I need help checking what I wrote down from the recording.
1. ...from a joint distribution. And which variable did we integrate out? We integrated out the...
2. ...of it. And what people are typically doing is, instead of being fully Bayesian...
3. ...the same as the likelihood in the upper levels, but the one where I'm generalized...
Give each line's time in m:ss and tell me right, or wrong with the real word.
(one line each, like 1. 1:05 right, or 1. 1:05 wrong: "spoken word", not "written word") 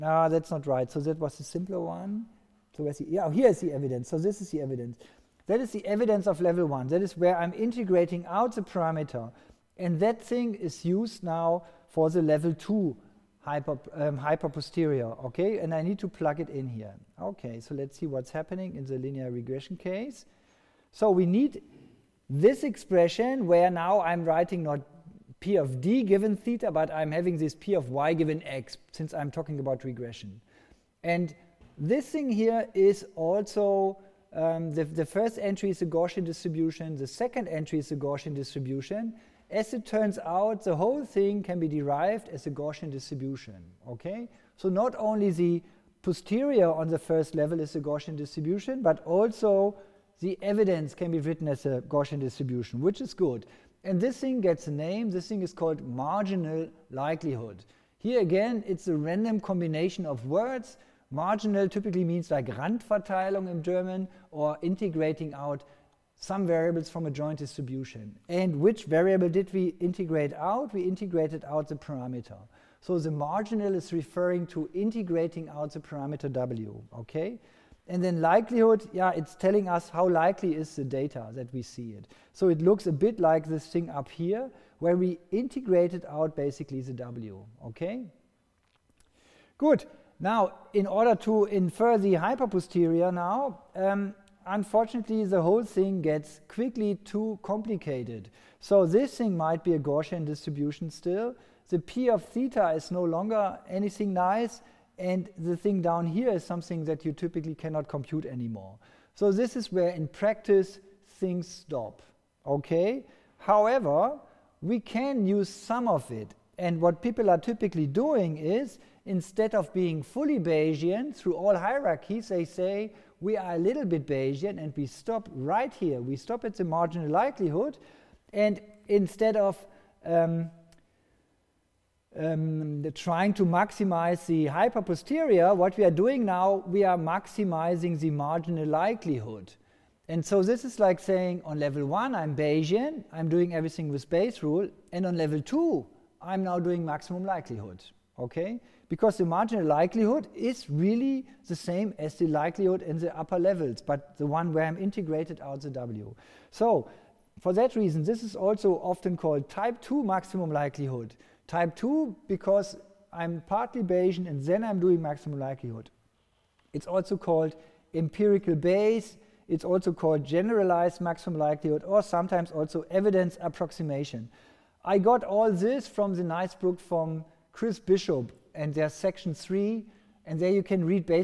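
1. 1:06 right
2. 1:55 right
3. 2:31 wrong: "integrated", not "generalized".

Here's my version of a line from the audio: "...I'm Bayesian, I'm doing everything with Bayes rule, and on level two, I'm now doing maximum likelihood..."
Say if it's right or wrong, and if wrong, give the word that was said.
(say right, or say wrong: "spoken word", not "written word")
right.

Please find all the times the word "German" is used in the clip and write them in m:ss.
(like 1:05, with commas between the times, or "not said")
1:03.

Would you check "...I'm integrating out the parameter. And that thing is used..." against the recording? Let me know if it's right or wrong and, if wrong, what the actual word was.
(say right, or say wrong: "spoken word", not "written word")
right.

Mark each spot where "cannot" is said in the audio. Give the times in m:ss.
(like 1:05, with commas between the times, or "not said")
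1:47.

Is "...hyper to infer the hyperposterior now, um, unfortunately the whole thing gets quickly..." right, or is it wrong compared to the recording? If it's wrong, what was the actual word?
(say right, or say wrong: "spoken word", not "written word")
wrong: "order", not "hyper".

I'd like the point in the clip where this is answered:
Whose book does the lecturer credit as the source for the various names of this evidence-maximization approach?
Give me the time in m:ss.
2:57.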